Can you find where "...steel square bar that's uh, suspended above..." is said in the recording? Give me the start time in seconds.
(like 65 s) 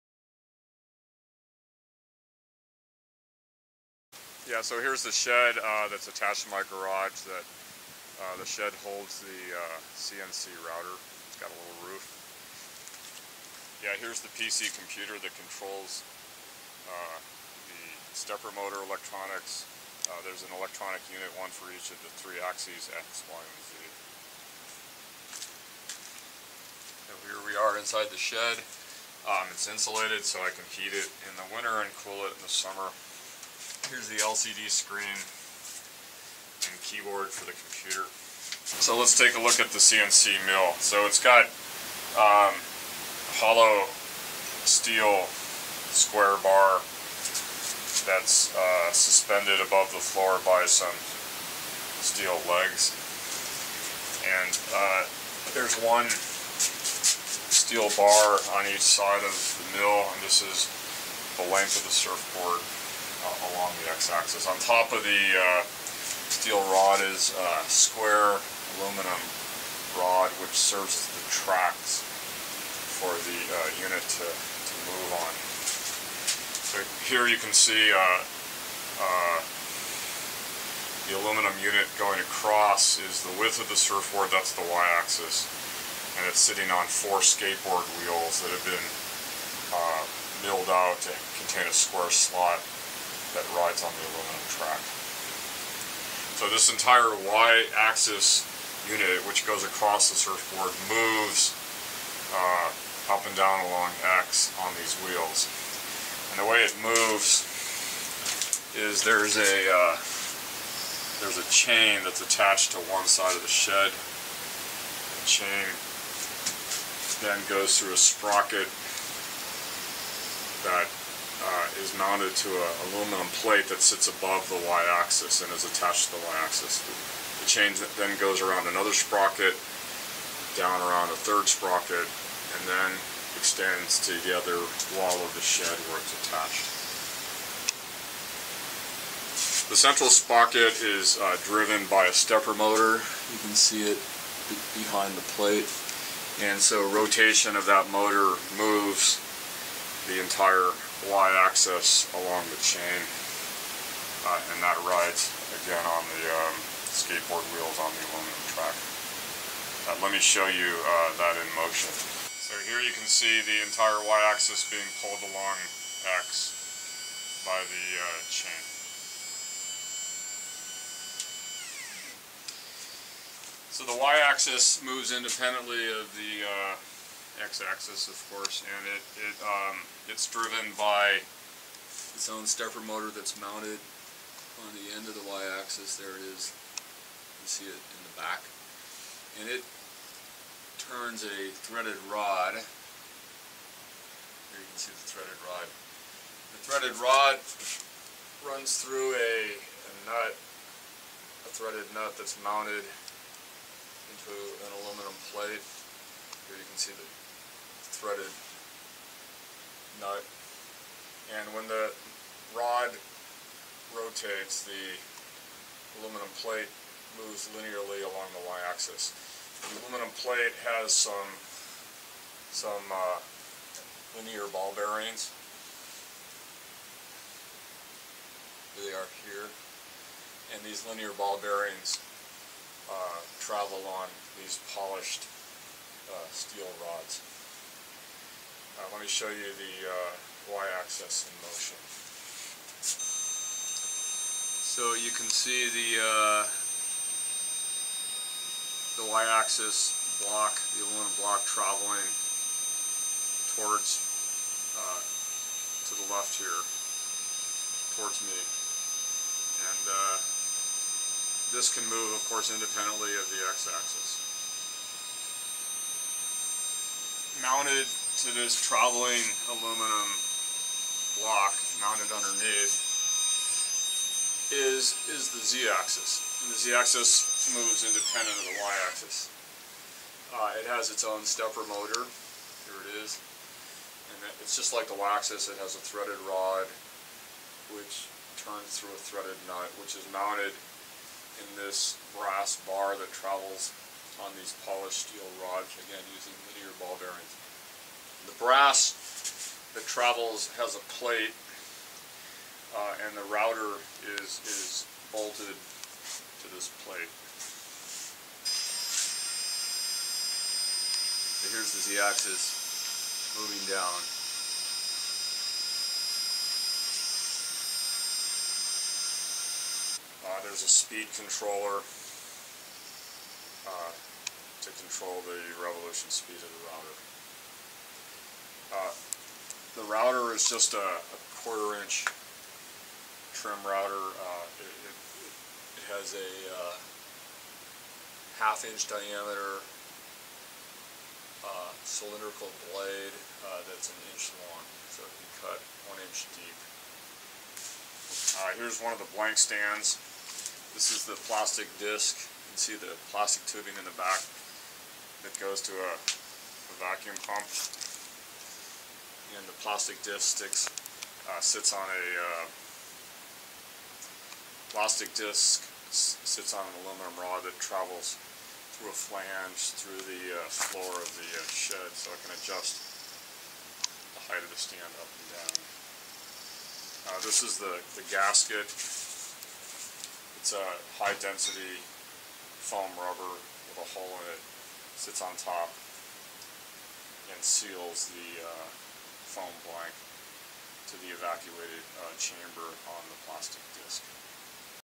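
44 s.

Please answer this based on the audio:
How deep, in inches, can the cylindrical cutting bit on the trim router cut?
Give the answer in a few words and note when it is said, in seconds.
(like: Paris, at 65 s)
1 inch, at 345 s.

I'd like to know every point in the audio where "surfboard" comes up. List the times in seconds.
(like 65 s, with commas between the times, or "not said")
61 s, 83 s, 100 s.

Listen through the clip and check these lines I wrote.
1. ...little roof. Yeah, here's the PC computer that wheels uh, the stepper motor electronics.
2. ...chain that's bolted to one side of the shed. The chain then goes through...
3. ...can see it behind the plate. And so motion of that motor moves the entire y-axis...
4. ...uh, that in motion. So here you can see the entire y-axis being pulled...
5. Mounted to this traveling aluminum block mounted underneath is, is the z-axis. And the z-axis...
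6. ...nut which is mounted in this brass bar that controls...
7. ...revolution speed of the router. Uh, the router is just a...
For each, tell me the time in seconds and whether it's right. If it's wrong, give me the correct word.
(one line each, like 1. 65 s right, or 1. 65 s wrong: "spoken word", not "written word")
1. 11 s wrong: "controls", not "wheels"
2. 111 s wrong: "attached", not "bolted"
3. 143 s wrong: "rotation", not "motion"
4. 160 s right
5. 267 s right
6. 289 s wrong: "travels", not "controls"
7. 325 s right.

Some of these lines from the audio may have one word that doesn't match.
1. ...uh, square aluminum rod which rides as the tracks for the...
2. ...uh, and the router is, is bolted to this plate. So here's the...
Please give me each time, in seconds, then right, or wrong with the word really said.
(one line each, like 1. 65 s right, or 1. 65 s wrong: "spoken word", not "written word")
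1. 67 s wrong: "serves", not "rides"
2. 302 s right.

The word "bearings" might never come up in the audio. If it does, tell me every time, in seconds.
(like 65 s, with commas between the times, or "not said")
224 s, 231 s, 297 s.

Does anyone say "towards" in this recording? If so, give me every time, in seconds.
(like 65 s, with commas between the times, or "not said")
253 s, 258 s.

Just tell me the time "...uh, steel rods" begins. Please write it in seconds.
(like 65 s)
236 s.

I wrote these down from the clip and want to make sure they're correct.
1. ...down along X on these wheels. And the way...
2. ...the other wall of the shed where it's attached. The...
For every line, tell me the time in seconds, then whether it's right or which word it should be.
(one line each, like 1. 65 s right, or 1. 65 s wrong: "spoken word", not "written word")
1. 103 s right
2. 134 s right.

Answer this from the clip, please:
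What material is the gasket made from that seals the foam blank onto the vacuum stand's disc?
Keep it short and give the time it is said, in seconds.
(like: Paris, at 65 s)
high density foam rubber, at 381 s.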